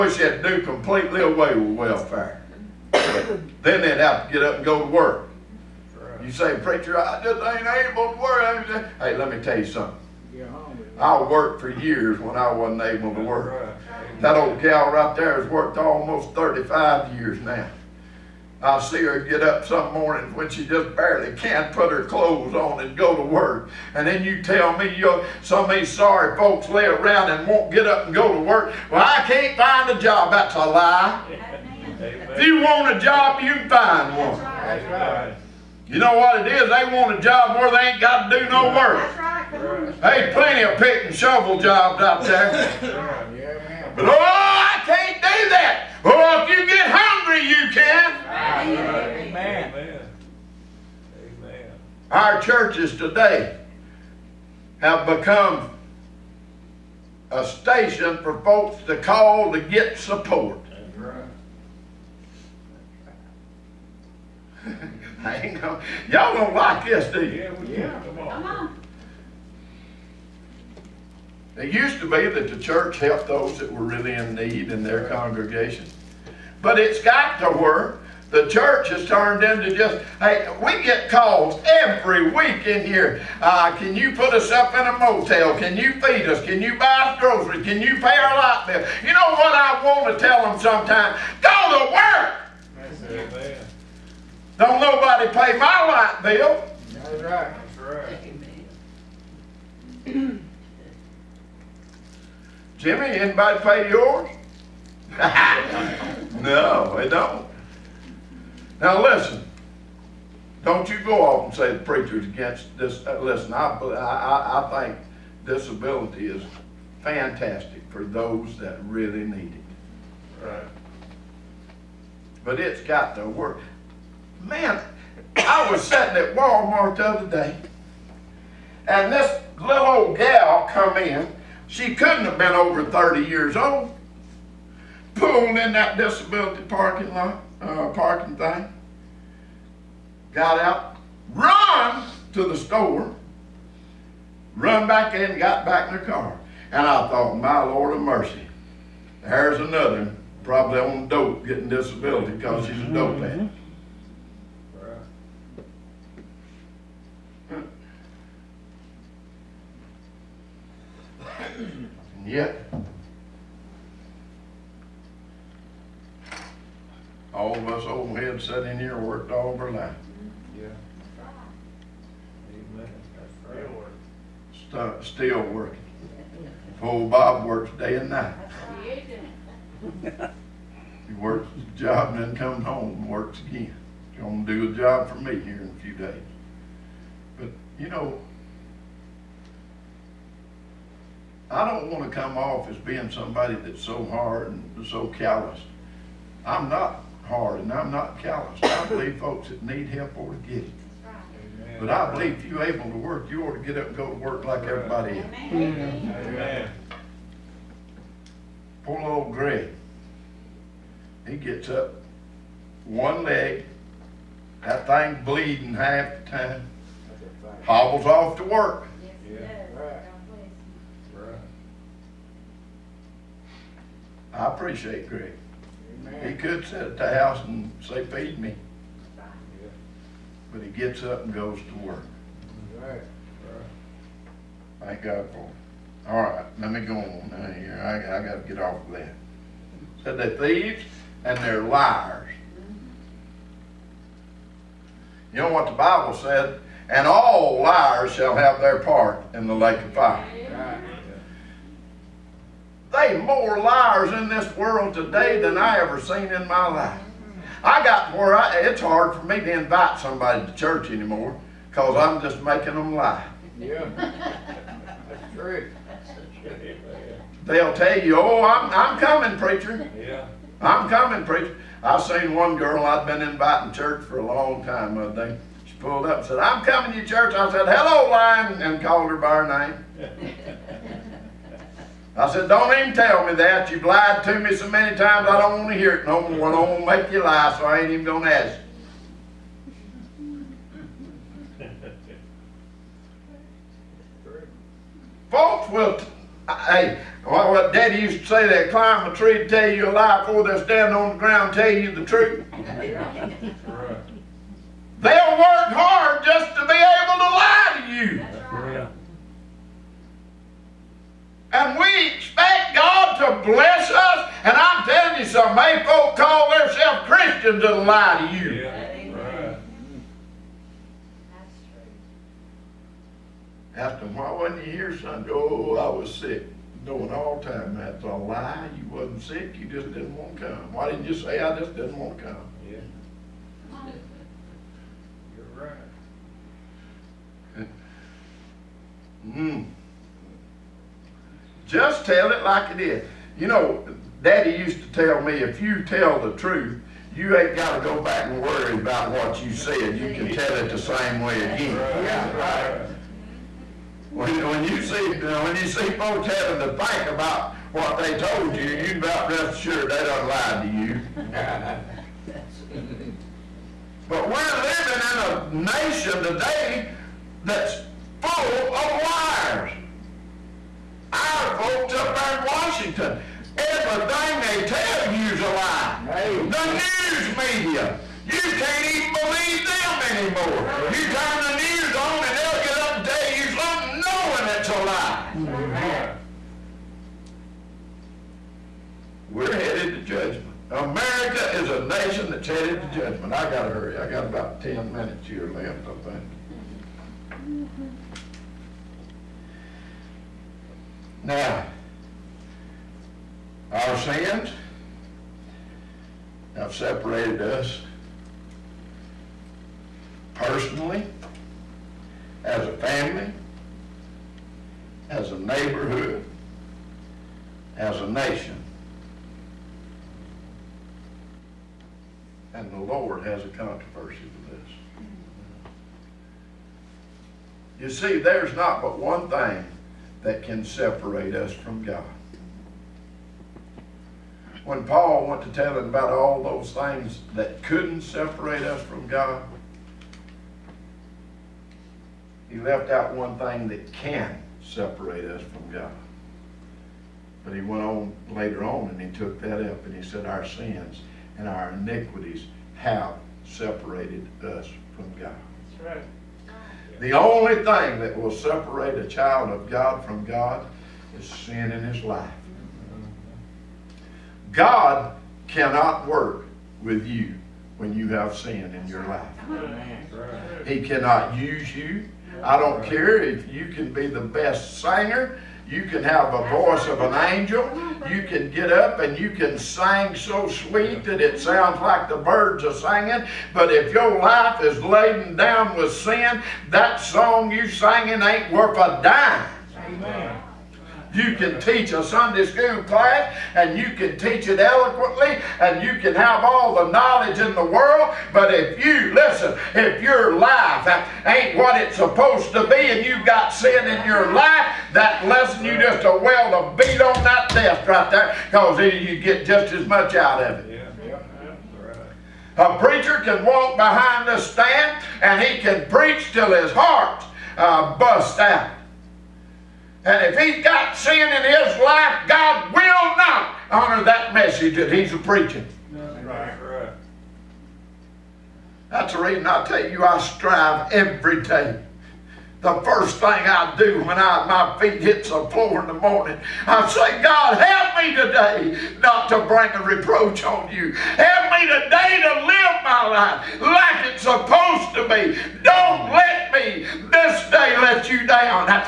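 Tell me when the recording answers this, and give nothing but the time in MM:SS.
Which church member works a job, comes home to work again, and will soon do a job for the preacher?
02:57.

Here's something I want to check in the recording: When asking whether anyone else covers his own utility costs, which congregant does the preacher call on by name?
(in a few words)
Jimmy.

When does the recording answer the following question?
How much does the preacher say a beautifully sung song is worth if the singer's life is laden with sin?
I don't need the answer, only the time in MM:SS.
08:08.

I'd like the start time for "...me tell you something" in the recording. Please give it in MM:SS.
00:09.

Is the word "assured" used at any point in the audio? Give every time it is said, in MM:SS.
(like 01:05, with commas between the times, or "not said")
05:59.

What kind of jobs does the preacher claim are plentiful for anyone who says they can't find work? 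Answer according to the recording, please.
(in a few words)
pick and shovel jobs.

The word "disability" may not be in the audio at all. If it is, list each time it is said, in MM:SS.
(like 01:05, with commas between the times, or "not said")
01:55, 02:15, 02:31.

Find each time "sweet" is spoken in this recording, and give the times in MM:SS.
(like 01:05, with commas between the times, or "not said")
08:00.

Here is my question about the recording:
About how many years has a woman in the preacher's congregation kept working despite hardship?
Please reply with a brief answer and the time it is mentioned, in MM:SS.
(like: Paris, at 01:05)
35, at 00:16.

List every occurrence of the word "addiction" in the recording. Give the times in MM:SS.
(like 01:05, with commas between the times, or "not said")
not said.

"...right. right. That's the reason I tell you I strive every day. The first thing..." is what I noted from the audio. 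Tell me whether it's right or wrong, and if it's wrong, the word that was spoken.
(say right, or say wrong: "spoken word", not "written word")
right.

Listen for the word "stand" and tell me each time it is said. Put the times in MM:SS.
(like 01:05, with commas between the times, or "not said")
05:00, 08:34.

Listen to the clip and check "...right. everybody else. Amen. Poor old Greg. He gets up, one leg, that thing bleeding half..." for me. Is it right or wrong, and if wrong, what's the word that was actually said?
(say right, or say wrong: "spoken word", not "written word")
right.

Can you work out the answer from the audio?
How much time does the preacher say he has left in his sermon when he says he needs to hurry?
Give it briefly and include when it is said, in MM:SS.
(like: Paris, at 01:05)
10 minutes, at 06:34.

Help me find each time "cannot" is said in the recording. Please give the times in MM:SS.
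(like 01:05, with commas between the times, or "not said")
07:45, 07:50.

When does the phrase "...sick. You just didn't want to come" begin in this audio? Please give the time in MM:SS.
05:29.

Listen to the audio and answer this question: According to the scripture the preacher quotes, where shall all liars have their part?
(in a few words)
the lake of fire.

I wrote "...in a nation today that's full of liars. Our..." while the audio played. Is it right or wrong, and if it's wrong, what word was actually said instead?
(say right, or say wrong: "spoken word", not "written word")
right.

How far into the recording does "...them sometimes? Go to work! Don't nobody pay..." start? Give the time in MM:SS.
01:30.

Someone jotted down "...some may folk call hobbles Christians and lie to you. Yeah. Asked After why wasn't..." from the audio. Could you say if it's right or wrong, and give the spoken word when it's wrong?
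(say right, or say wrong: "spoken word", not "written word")
wrong: "themselves", not "hobbles".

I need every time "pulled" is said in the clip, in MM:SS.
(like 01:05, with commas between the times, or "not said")
02:15, 04:35.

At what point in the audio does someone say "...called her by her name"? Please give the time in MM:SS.
04:38.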